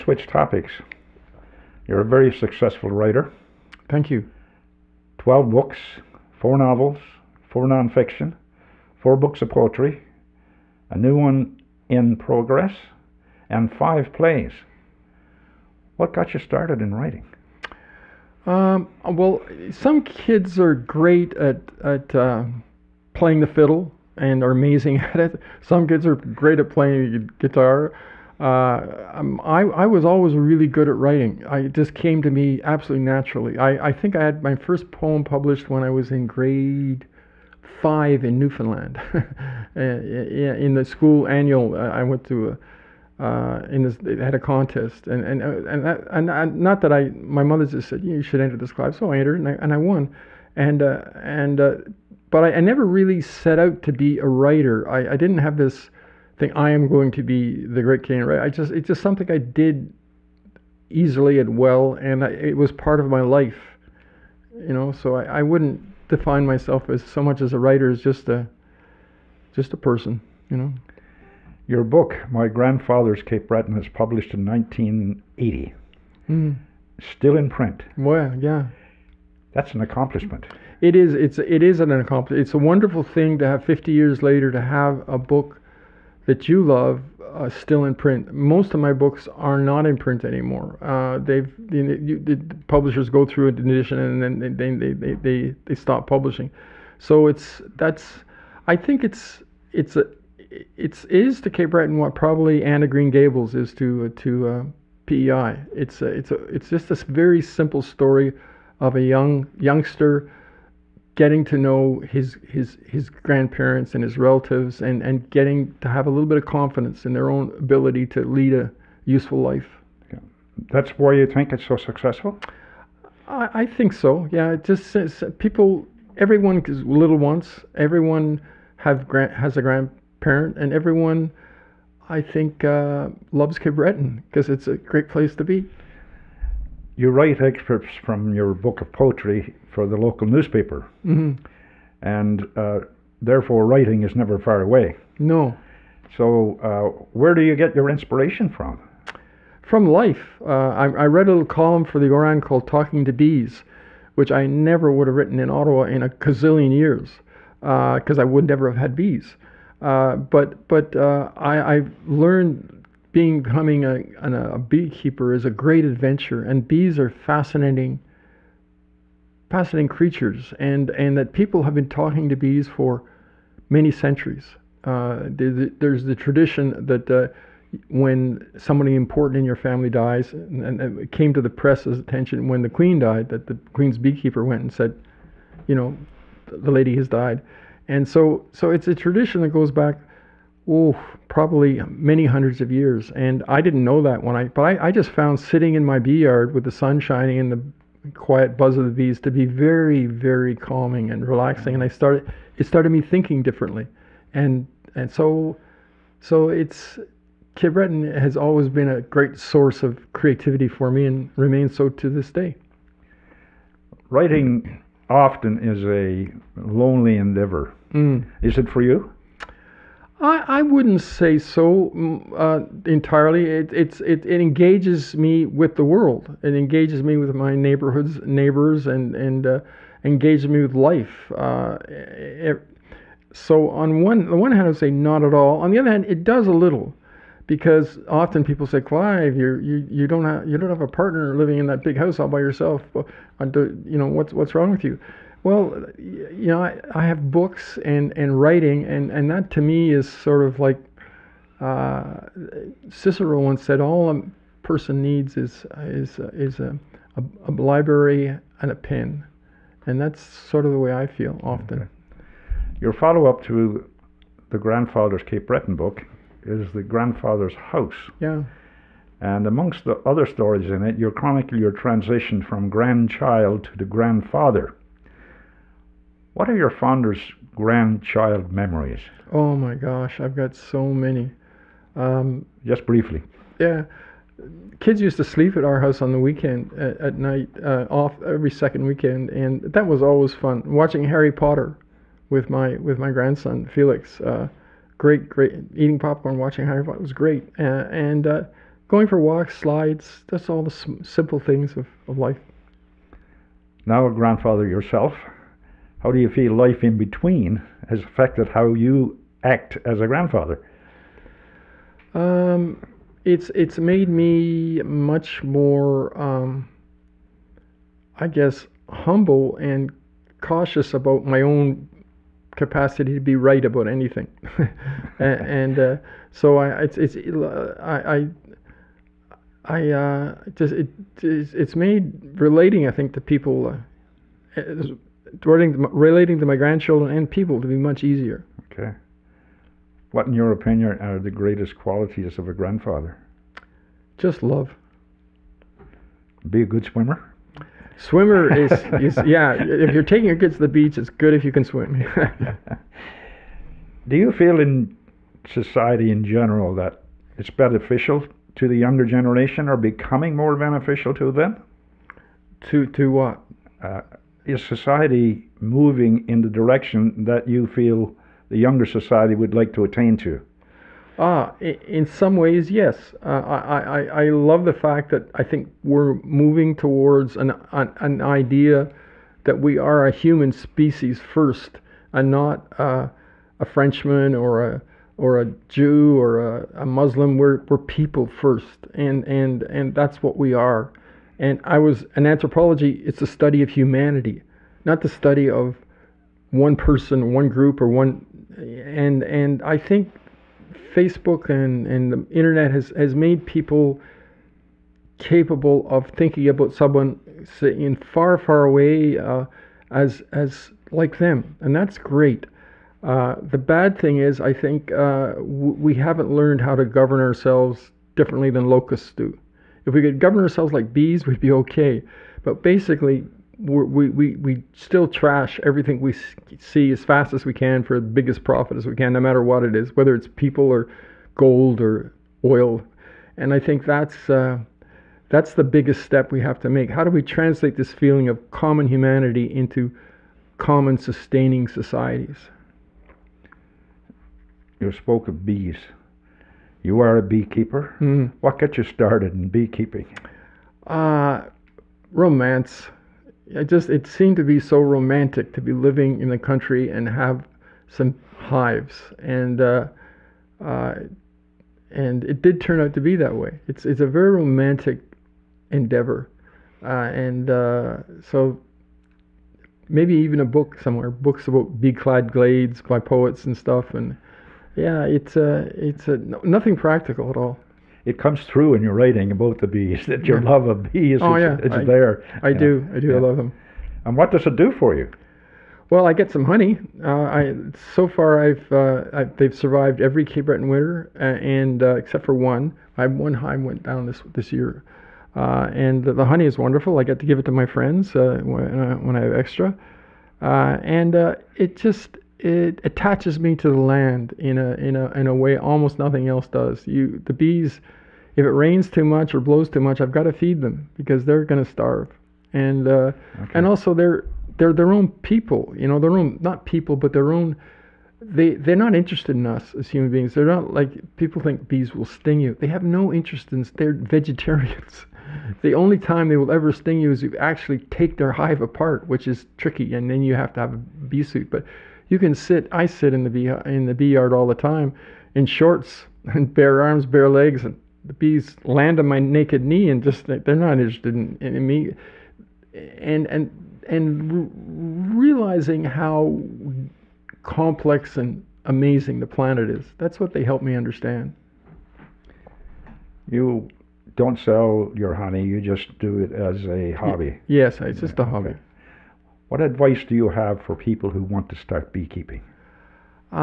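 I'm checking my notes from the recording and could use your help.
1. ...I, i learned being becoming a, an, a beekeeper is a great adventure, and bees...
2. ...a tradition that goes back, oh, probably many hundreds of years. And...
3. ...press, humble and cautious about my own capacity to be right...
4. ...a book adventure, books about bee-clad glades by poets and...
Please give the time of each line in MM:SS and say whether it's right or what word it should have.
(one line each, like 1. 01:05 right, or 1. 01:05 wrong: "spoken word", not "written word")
1. 02:41 right
2. 03:08 right
3. 05:18 wrong: "guess", not "press"
4. 07:50 wrong: "somewhere", not "adventure".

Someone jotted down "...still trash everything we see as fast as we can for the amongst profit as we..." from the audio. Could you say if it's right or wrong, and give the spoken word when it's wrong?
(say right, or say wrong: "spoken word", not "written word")
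wrong: "biggest", not "amongst".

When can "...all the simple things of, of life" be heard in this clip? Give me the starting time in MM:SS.
05:00.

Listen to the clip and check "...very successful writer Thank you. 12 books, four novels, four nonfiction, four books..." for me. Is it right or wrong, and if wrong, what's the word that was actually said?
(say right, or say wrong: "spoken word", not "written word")
right.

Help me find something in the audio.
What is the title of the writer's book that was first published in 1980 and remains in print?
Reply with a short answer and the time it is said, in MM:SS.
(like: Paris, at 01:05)
My Grandfather's Cape Breton, at 01:12.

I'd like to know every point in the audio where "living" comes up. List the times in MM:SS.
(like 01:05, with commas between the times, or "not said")
04:01, 07:35.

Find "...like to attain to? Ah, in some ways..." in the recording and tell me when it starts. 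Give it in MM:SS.
06:09.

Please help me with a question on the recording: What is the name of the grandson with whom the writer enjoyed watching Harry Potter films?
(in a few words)
Felix.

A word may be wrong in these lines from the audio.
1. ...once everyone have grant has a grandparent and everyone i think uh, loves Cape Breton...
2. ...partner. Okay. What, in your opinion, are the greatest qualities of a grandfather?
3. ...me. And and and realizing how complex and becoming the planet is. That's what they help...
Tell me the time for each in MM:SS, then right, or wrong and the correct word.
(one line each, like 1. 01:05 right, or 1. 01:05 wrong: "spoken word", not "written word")
1. 02:07 right
2. 05:38 wrong: "easier", not "partner"
3. 09:01 wrong: "amazing", not "becoming".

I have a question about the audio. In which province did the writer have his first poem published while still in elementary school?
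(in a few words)
Newfoundland.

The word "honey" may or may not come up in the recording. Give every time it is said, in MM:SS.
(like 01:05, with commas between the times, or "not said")
08:06, 08:16, 09:15.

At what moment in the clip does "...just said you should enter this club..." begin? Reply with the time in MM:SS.
00:47.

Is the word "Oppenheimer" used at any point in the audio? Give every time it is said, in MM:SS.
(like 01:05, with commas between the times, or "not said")
not said.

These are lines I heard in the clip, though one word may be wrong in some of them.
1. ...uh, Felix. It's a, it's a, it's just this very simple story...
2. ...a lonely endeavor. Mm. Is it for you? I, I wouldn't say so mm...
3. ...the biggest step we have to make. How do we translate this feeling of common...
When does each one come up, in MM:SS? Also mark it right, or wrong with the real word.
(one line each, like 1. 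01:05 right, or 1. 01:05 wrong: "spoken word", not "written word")
1. 01:44 wrong: "PEI", not "Felix"
2. 03:35 right
3. 07:15 right.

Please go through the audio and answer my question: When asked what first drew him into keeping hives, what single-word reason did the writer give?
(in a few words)
Romance.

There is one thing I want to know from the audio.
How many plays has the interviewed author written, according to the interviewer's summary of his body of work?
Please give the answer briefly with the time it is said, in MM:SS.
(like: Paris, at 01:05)
5, at 00:13.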